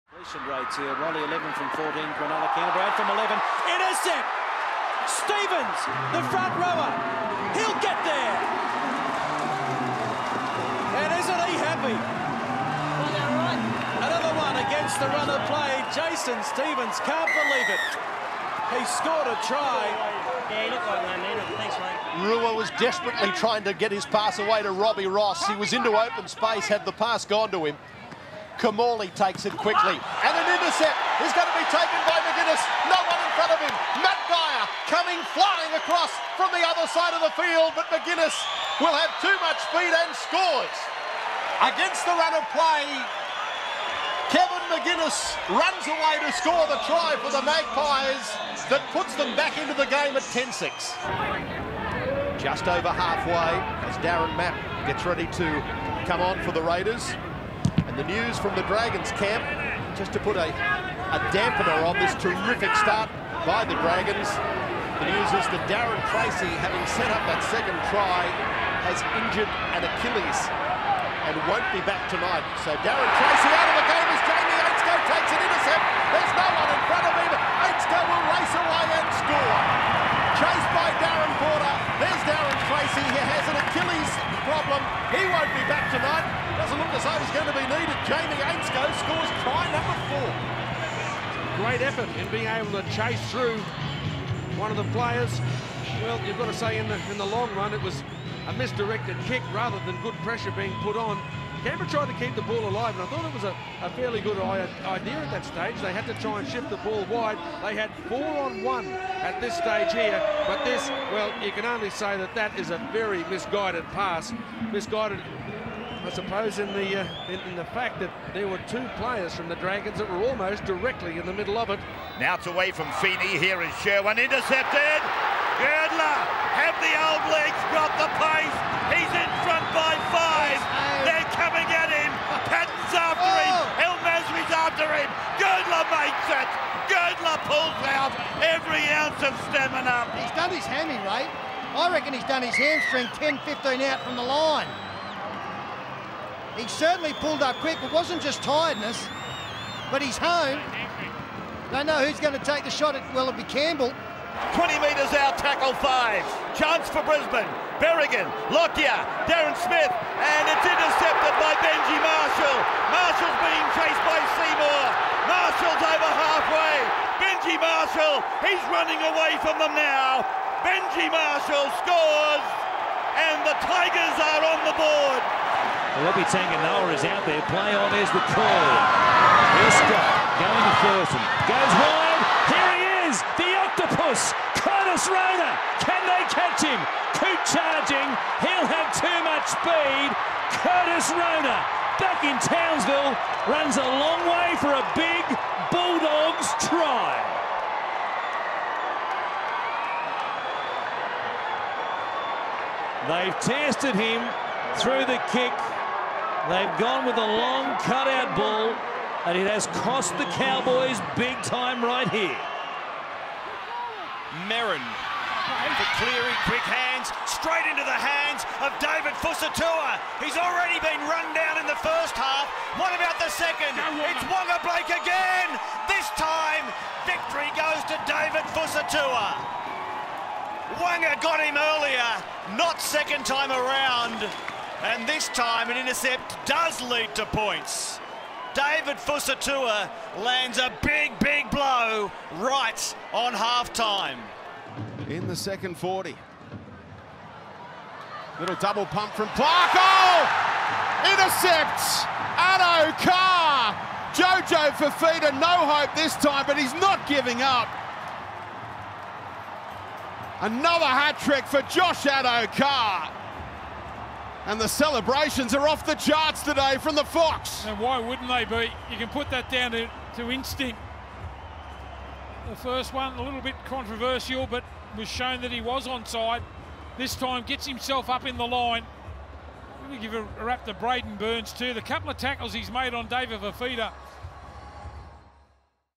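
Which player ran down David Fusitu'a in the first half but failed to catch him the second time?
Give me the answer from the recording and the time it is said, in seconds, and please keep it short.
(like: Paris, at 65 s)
Wonga Blake, at 224 s.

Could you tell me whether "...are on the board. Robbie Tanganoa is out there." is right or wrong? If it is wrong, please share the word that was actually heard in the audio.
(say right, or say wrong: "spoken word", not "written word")
right.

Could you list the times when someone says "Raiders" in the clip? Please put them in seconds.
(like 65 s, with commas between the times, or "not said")
56 s.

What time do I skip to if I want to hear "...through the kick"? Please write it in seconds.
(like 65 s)
204 s.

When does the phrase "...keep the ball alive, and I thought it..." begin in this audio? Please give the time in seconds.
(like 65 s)
102 s.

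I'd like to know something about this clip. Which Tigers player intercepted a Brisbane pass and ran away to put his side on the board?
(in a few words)
Benji Marshall.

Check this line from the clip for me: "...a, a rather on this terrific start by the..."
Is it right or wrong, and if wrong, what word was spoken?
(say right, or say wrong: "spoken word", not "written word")
wrong: "dampener", not "rather".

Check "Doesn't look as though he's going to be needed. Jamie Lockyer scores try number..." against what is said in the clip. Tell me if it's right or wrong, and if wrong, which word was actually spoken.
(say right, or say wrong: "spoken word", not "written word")
wrong: "Ainscough", not "Lockyer".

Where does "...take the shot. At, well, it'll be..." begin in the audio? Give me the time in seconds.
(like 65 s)
152 s.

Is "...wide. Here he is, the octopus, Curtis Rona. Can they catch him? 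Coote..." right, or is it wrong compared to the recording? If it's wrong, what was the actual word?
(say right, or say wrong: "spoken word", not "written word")
right.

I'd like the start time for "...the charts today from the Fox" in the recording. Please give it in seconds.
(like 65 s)
265 s.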